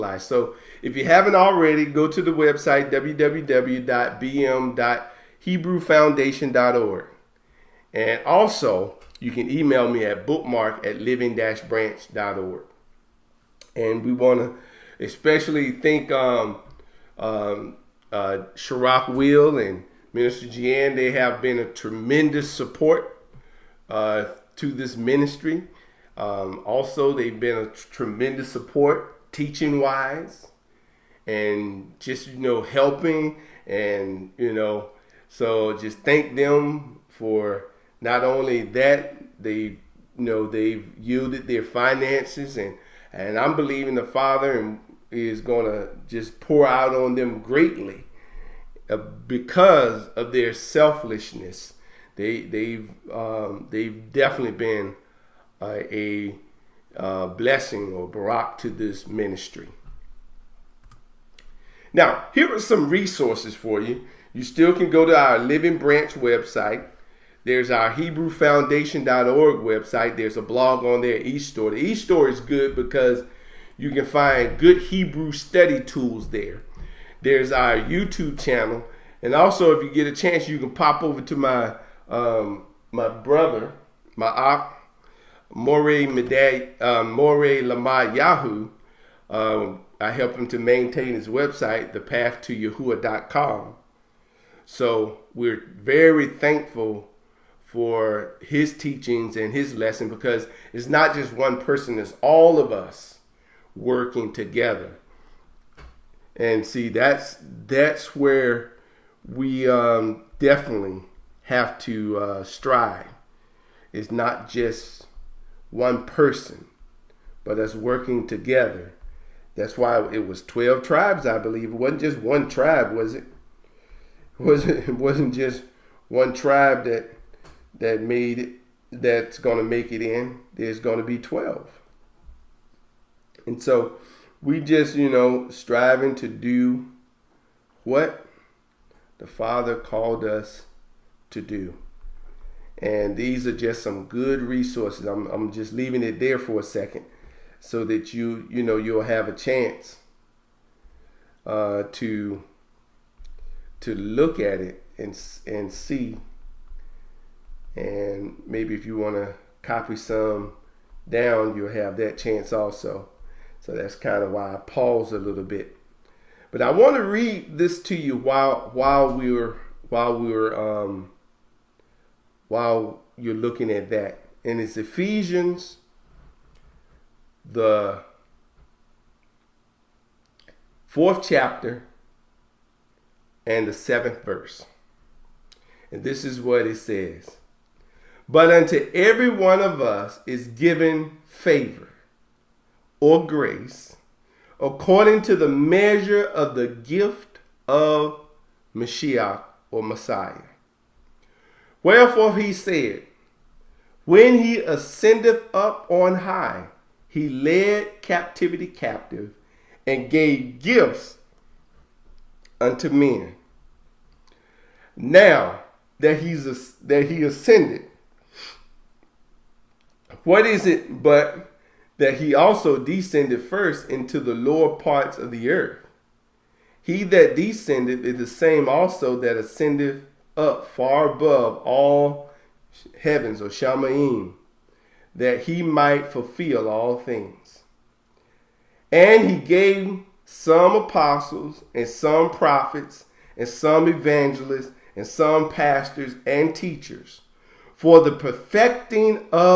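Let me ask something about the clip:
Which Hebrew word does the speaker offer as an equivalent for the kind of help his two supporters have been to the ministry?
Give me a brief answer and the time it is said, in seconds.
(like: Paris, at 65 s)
barak, at 58 s.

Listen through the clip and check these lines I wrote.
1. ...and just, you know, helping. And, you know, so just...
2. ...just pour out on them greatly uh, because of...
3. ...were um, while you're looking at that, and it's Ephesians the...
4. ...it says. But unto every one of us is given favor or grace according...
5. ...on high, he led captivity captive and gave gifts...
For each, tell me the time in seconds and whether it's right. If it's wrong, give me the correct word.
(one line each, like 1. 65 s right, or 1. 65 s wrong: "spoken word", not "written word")
1. 31 s right
2. 46 s right
3. 170 s right
4. 186 s right
5. 205 s right.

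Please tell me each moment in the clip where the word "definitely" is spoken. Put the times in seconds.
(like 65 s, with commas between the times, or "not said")
54 s, 110 s.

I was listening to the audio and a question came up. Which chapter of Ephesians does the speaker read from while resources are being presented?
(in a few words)
4th chapter.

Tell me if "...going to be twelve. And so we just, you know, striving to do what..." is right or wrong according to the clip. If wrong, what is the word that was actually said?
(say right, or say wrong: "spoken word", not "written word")
right.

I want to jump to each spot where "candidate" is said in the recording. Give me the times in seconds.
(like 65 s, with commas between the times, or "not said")
not said.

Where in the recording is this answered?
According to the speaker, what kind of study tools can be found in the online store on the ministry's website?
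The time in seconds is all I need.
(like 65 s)
74 s.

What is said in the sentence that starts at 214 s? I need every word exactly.
Now that he's that he ascended, what is it but that he also descended first into the lower parts of the earth.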